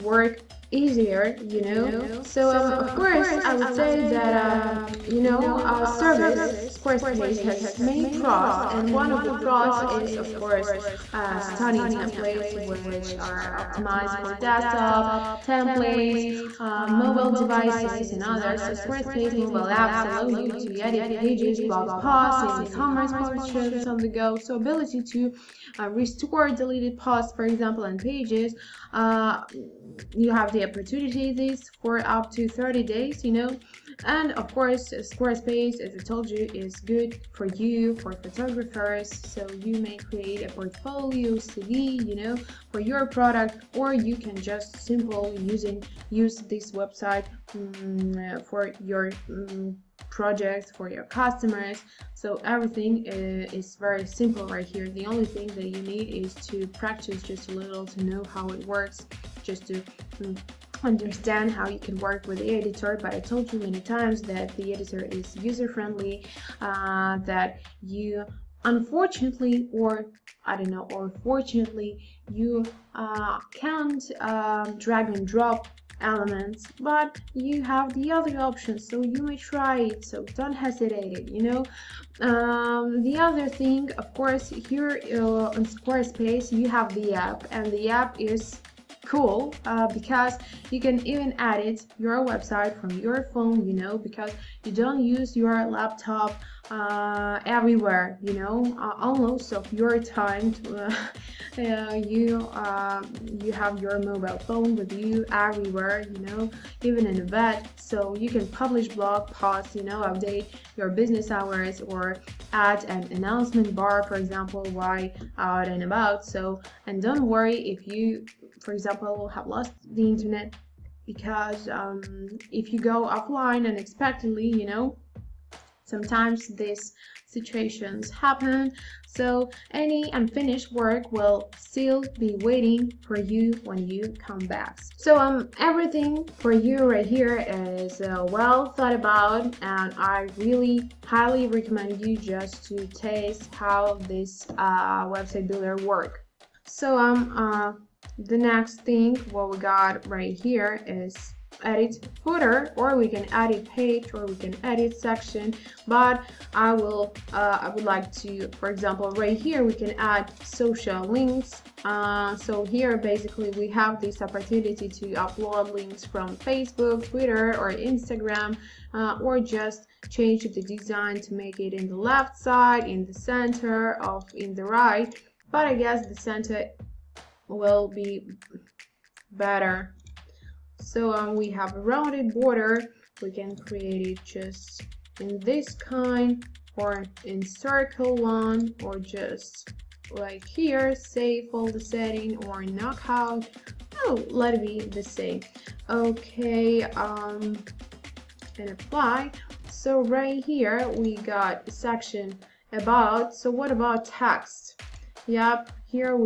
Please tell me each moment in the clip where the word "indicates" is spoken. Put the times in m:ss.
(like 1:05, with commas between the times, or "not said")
not said.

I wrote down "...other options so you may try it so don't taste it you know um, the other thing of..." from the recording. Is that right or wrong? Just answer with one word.
wrong.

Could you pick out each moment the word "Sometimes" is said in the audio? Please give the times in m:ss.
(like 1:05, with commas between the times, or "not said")
2:05.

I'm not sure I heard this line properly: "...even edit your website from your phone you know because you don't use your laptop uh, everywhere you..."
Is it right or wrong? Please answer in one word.
right.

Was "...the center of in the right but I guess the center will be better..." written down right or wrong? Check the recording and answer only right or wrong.
right.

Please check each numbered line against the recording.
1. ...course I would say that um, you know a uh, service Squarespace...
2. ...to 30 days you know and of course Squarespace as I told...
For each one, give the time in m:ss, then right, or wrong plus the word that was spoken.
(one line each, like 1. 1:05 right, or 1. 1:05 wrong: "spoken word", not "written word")
1. 0:02 right
2. 0:32 right.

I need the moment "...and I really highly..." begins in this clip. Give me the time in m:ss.
2:19.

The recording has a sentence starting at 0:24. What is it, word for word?
So ability to uh, restore deleted posts for example and pages.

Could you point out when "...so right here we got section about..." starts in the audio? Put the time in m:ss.
3:19.